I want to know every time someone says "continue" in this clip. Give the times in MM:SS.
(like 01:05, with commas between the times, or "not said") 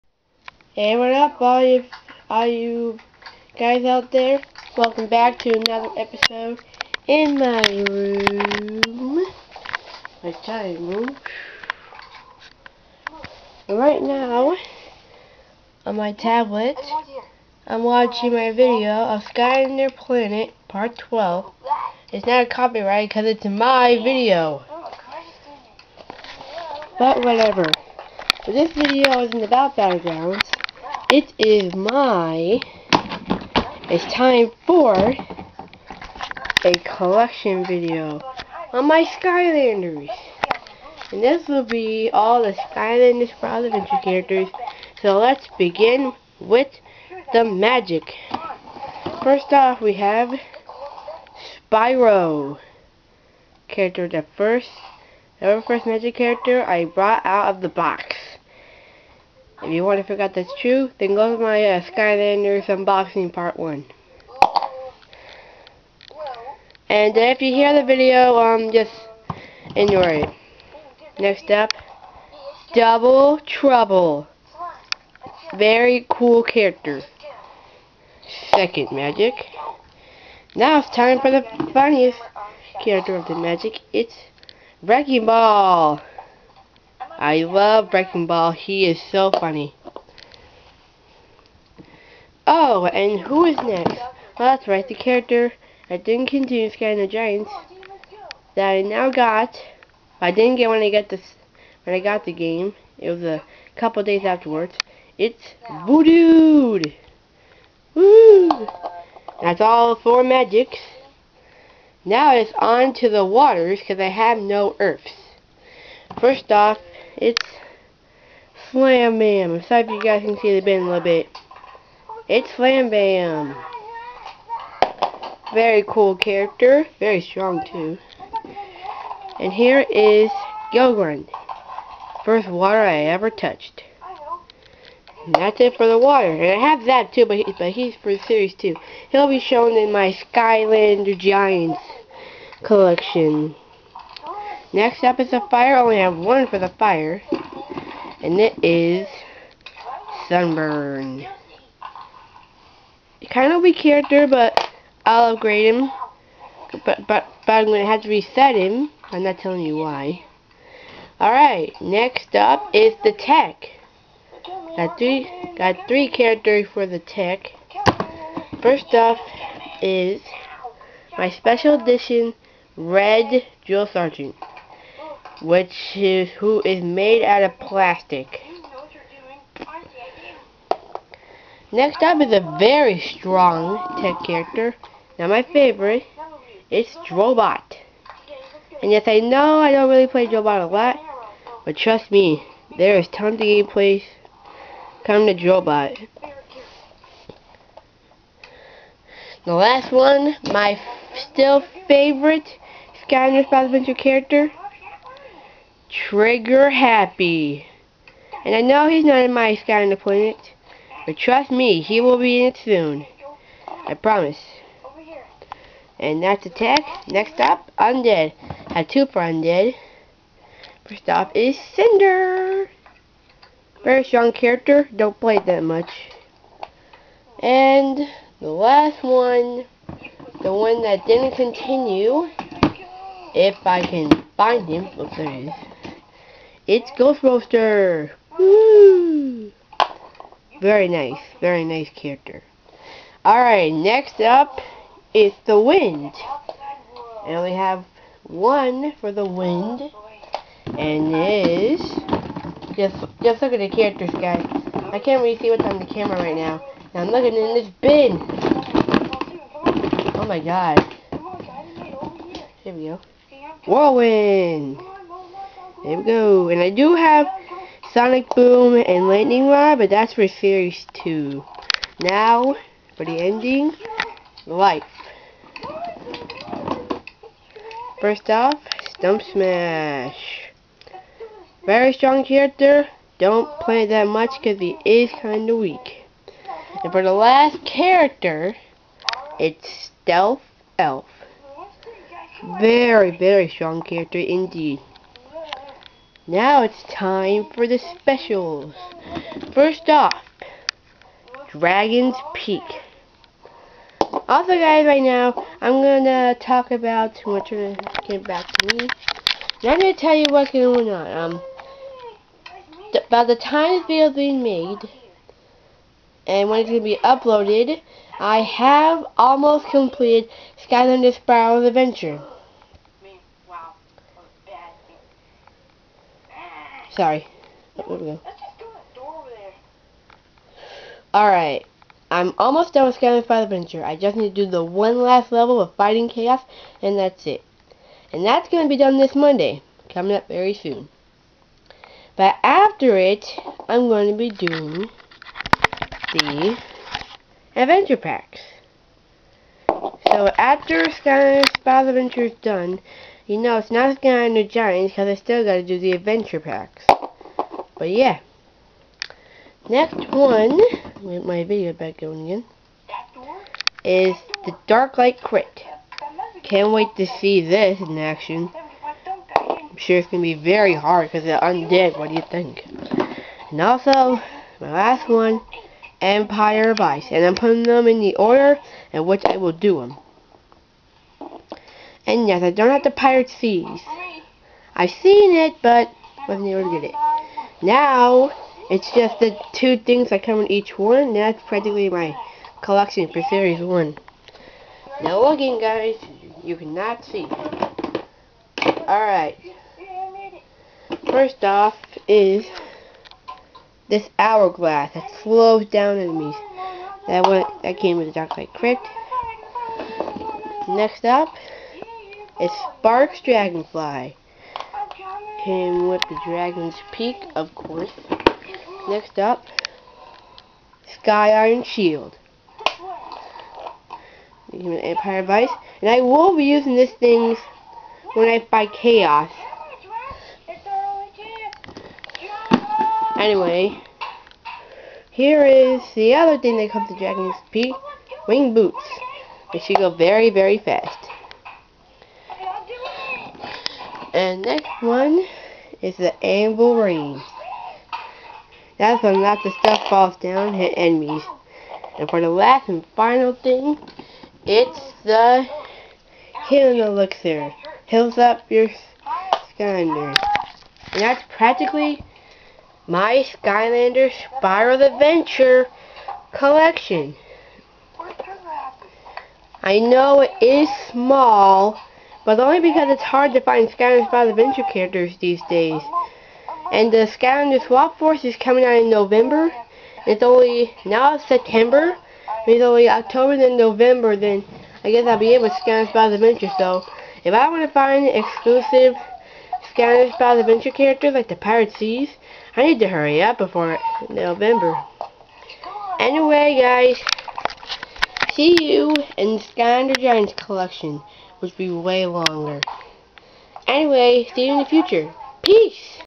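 01:36, 03:51.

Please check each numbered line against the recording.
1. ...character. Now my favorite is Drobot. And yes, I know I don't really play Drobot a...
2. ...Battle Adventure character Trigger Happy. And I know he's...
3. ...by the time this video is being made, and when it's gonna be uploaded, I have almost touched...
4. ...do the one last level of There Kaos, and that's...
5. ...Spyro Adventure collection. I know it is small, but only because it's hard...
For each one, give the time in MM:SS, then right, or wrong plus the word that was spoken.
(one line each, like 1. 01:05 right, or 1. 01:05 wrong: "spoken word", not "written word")
1. 03:04 right
2. 03:23 right
3. 05:13 wrong: "completed", not "touched"
4. 05:34 wrong: "Fighting", not "There"
5. 07:44 right.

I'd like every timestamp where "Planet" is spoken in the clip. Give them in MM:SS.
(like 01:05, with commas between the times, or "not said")
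00:19, 03:30.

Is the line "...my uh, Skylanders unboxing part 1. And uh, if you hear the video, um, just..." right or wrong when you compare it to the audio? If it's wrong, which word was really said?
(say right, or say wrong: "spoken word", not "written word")
right.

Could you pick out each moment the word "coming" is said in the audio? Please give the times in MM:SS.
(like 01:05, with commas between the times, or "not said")
05:39, 07:58.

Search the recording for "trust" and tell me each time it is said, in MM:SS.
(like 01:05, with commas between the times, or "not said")
03:11, 03:31.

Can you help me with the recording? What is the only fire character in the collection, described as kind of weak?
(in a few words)
Sunburn.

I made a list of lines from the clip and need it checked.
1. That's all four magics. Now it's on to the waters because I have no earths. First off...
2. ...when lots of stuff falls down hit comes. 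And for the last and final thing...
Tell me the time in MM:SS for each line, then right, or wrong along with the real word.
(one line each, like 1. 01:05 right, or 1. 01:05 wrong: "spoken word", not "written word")
1. 01:49 right
2. 07:29 wrong: "enemies", not "comes".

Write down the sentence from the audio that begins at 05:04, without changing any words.
Also guys, right now, I'm gonna talk about, I'm gonna get back to me.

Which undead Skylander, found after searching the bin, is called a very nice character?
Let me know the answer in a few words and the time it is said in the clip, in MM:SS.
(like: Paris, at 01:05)
Ghost Roaster, at 03:56.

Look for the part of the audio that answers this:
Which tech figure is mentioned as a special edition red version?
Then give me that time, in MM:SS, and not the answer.
02:53.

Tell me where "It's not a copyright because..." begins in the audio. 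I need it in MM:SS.
00:22.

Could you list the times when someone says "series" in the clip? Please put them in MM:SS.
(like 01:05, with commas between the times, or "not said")
02:18, 04:30, 06:33.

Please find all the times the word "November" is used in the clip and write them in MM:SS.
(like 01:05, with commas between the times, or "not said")
07:58, 08:03, 08:14.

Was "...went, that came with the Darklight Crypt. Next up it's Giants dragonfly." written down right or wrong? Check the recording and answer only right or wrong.
wrong.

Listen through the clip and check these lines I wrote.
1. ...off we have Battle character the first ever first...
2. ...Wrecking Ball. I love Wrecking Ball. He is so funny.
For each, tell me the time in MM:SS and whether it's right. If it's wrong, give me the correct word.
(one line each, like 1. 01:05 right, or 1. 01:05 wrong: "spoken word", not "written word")
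1. 00:49 wrong: "Spyro", not "Battle"
2. 01:24 right.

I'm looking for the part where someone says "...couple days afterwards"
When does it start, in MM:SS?
01:43.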